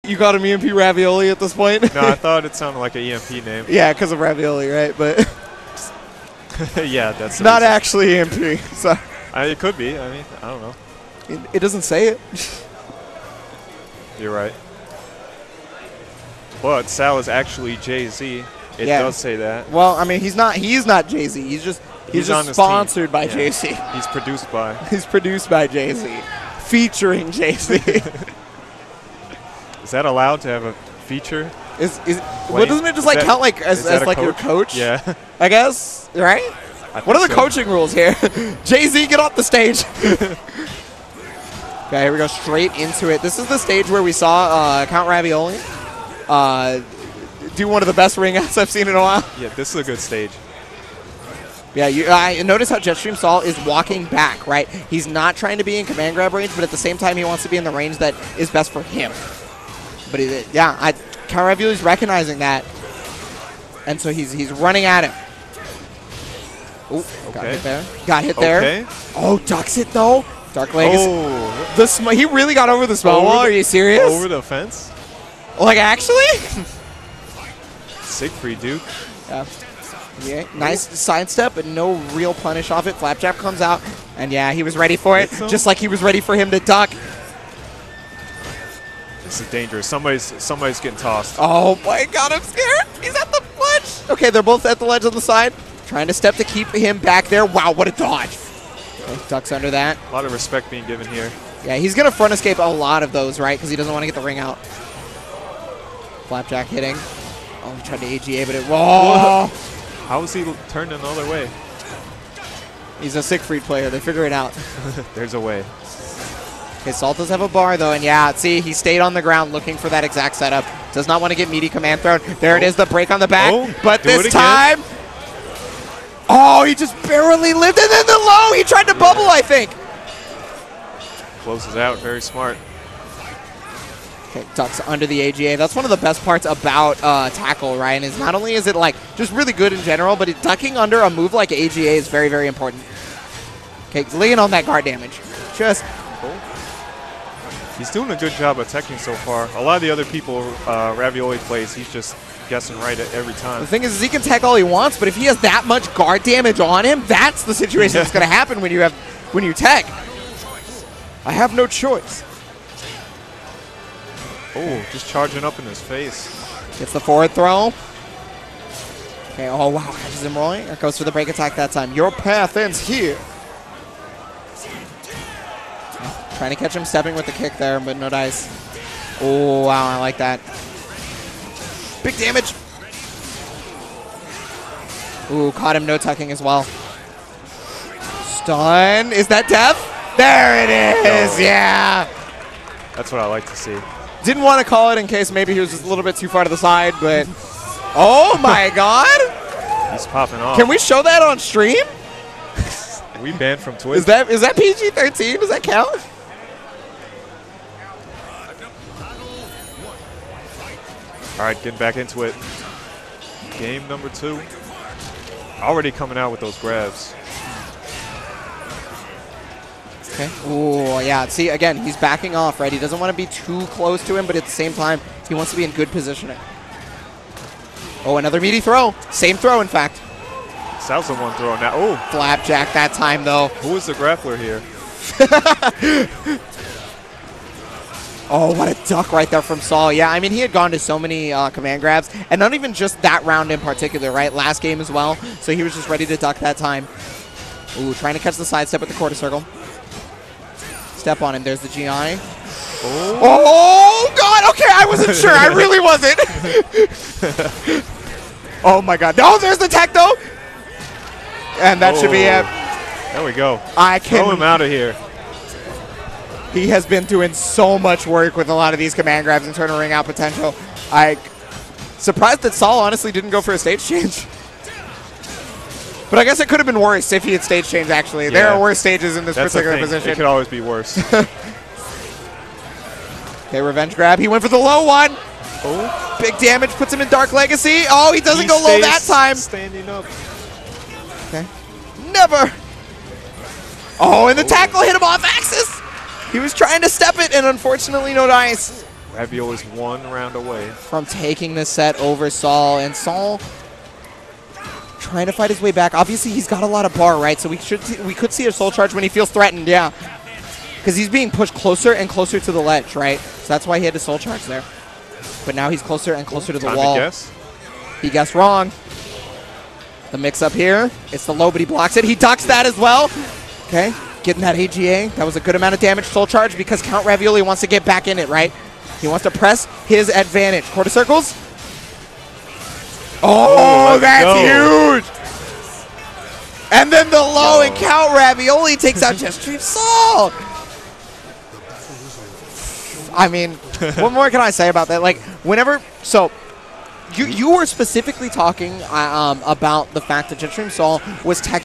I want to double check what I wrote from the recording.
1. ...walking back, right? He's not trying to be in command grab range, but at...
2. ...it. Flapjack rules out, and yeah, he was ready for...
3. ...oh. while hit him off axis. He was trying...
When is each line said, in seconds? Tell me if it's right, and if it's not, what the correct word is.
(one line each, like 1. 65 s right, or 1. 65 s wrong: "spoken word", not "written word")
1. 53 s right
2. 82 s wrong: "comes", not "rules"
3. 294 s wrong: "tackle", not "while".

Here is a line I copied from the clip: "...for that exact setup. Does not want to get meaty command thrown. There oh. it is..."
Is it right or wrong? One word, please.
right.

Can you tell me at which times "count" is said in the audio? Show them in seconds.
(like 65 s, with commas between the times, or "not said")
33 s, 44 s, 205 s, 326 s, 337 s.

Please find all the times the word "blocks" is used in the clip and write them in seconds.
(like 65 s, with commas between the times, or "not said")
321 s.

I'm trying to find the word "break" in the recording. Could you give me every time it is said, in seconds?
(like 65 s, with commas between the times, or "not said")
122 s, 171 s.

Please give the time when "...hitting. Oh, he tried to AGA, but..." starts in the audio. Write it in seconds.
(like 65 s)
106 s.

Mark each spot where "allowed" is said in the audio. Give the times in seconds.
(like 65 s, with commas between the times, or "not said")
30 s.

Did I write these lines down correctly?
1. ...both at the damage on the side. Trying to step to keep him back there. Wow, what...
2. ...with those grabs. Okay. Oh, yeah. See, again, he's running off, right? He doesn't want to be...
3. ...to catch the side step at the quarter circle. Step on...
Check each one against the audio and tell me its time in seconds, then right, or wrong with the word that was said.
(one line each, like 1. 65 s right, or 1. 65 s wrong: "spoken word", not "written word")
1. 94 s wrong: "ledge", not "damage"
2. 216 s wrong: "backing", not "running"
3. 248 s right.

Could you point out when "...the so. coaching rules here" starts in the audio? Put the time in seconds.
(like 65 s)
37 s.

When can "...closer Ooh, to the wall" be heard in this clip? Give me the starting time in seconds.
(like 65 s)
316 s.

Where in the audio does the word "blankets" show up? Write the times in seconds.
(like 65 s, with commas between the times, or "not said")
not said.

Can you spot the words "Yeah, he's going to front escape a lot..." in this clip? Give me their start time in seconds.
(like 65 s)
101 s.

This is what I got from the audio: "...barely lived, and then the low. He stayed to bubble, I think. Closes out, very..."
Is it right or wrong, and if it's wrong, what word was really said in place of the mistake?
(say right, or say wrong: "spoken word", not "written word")
wrong: "tried", not "stayed".